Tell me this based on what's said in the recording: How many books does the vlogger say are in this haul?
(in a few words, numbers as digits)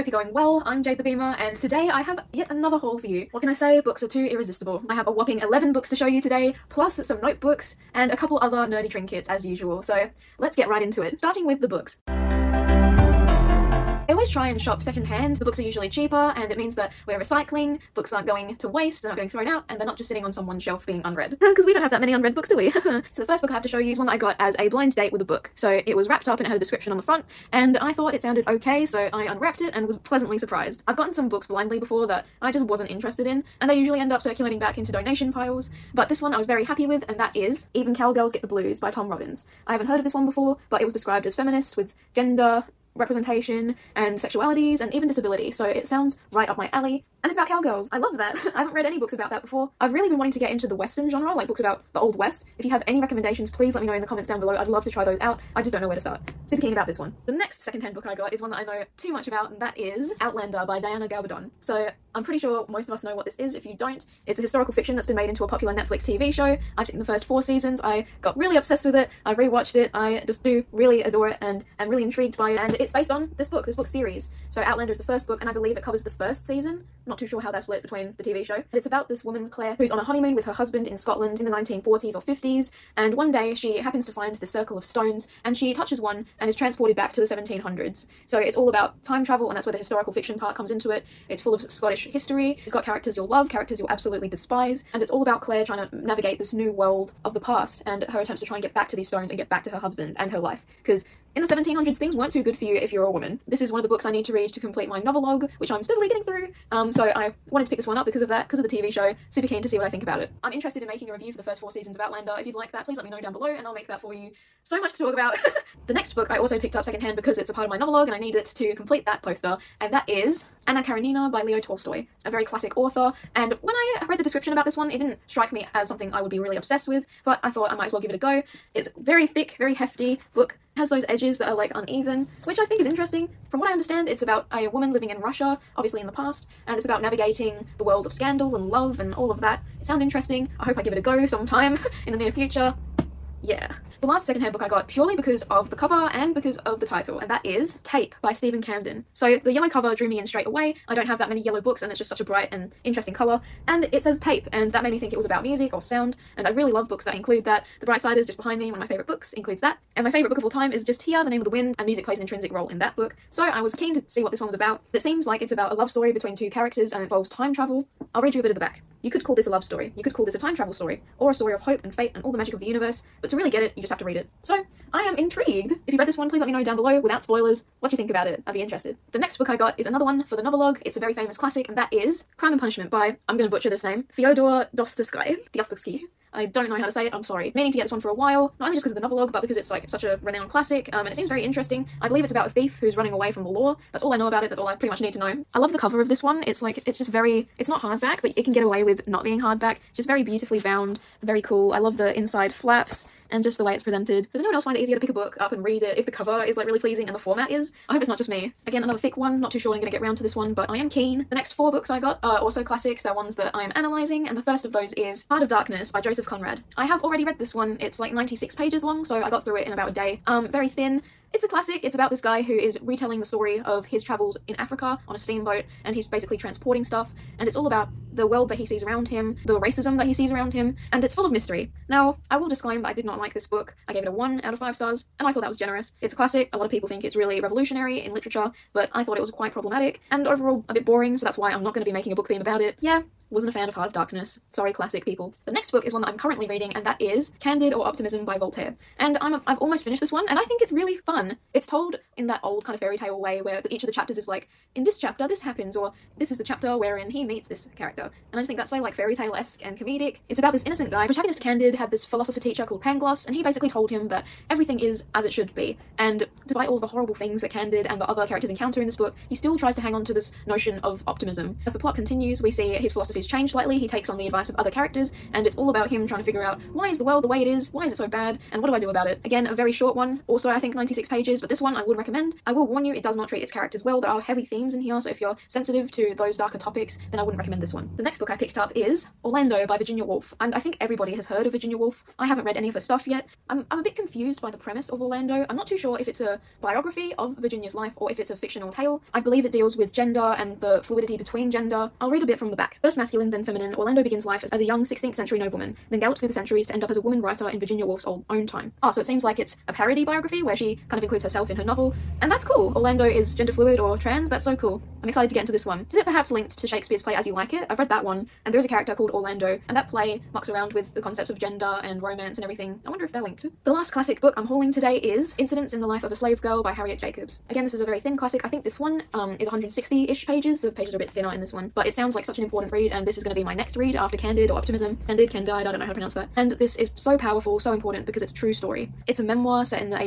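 11.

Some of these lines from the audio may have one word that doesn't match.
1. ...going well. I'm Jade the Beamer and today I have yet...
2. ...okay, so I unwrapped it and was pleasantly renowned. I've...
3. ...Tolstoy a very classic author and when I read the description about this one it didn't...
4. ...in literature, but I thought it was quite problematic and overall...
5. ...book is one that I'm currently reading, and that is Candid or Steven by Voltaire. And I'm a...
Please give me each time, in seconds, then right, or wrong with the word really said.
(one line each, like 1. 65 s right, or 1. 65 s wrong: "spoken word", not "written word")
1. 0 s right
2. 28 s wrong: "surprised", not "renowned"
3. 121 s right
4. 237 s right
5. 245 s wrong: "Optimism", not "Steven".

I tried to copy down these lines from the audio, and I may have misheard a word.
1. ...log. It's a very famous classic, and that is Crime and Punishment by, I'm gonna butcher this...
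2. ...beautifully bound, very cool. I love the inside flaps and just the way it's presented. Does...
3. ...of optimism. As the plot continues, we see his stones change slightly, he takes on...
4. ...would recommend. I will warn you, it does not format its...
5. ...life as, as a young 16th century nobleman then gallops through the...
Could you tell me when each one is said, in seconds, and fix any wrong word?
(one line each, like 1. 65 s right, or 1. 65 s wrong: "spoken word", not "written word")
1. 180 s right
2. 200 s right
3. 270 s wrong: "philosophies", not "stones"
4. 281 s wrong: "treat", not "format"
5. 304 s right.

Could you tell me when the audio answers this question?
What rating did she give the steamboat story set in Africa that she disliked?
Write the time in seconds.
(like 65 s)
234 s.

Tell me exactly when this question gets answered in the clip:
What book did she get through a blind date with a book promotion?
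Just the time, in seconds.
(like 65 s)
37 s.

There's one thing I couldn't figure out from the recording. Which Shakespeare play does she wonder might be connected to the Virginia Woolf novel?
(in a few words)
As You Like It.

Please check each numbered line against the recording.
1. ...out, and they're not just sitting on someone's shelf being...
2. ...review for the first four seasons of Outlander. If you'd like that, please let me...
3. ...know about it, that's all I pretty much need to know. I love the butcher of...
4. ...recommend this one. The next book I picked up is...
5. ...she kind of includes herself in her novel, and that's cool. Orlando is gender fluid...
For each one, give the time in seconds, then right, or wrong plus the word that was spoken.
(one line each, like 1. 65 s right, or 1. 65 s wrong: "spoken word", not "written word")
1. 19 s right
2. 111 s right
3. 194 s wrong: "cover", not "butcher"
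4. 287 s right
5. 310 s right.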